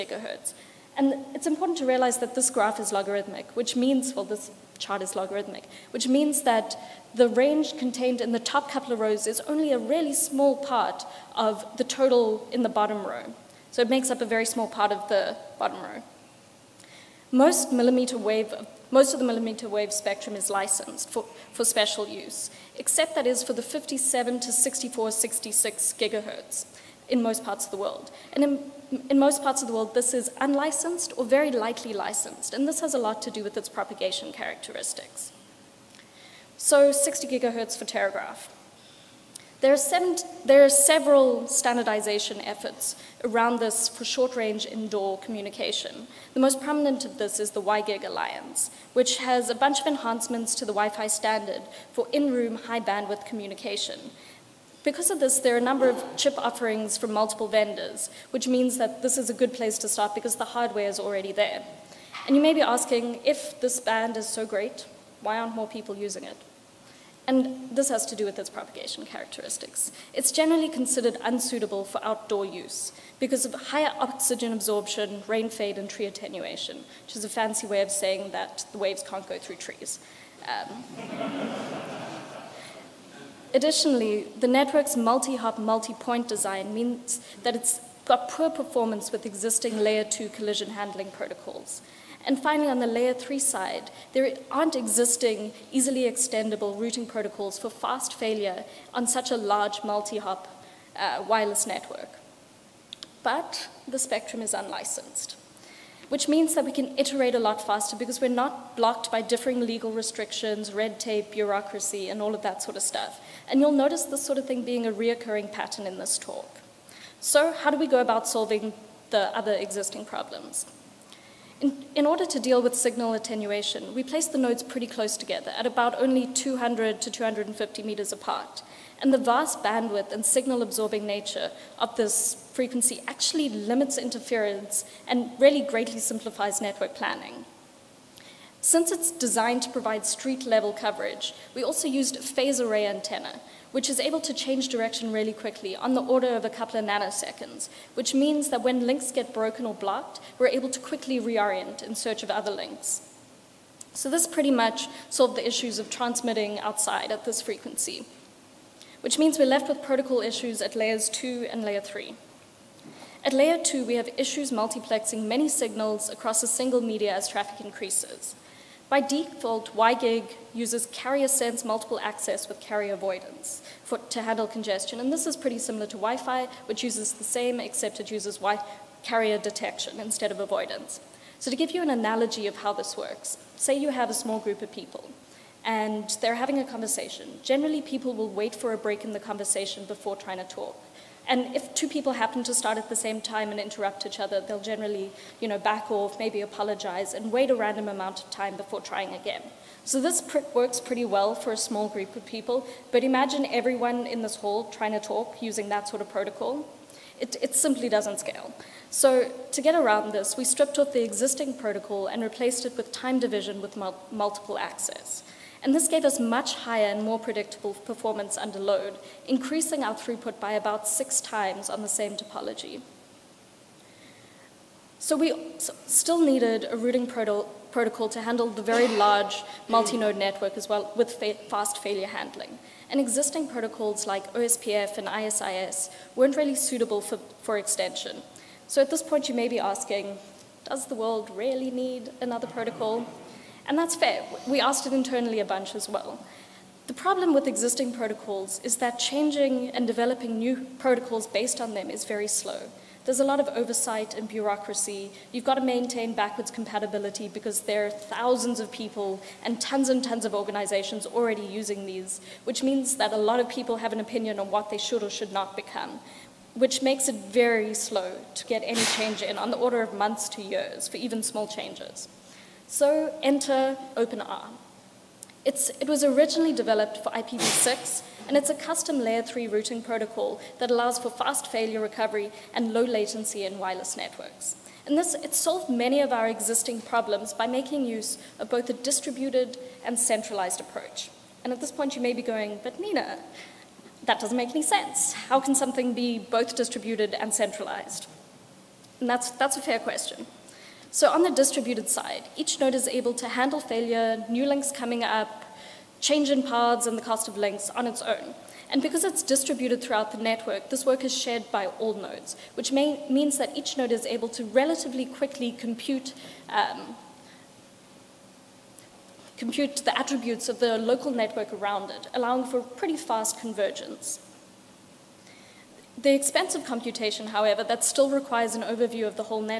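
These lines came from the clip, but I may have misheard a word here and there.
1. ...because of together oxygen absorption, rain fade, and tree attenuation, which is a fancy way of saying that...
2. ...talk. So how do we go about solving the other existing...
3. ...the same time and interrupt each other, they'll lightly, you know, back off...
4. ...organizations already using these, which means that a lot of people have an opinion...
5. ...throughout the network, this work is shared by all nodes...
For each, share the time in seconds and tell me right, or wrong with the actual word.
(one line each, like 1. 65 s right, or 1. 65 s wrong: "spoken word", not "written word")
1. 73 s wrong: "higher", not "together"
2. 116 s right
3. 192 s wrong: "generally", not "lightly"
4. 260 s right
5. 309 s right.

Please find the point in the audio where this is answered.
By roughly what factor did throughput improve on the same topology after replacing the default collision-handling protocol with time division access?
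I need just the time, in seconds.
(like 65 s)
220 s.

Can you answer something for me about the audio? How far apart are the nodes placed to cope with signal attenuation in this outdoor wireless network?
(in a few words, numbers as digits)
200 to 250 meters.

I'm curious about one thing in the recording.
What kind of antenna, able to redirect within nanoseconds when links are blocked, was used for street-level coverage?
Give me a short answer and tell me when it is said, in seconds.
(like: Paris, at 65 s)
phase array antenna, at 142 s.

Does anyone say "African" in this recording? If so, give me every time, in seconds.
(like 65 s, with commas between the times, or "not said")
not said.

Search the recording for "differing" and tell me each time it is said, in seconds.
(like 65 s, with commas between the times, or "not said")
109 s.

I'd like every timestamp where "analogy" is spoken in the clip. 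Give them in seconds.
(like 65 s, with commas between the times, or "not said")
181 s.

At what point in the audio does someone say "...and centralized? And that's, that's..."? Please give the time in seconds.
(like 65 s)
297 s.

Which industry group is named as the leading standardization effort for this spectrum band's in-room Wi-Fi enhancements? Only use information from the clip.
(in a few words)
WiGig Alliance.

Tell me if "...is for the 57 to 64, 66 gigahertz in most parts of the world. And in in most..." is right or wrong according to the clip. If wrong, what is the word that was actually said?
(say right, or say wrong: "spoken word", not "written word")
right.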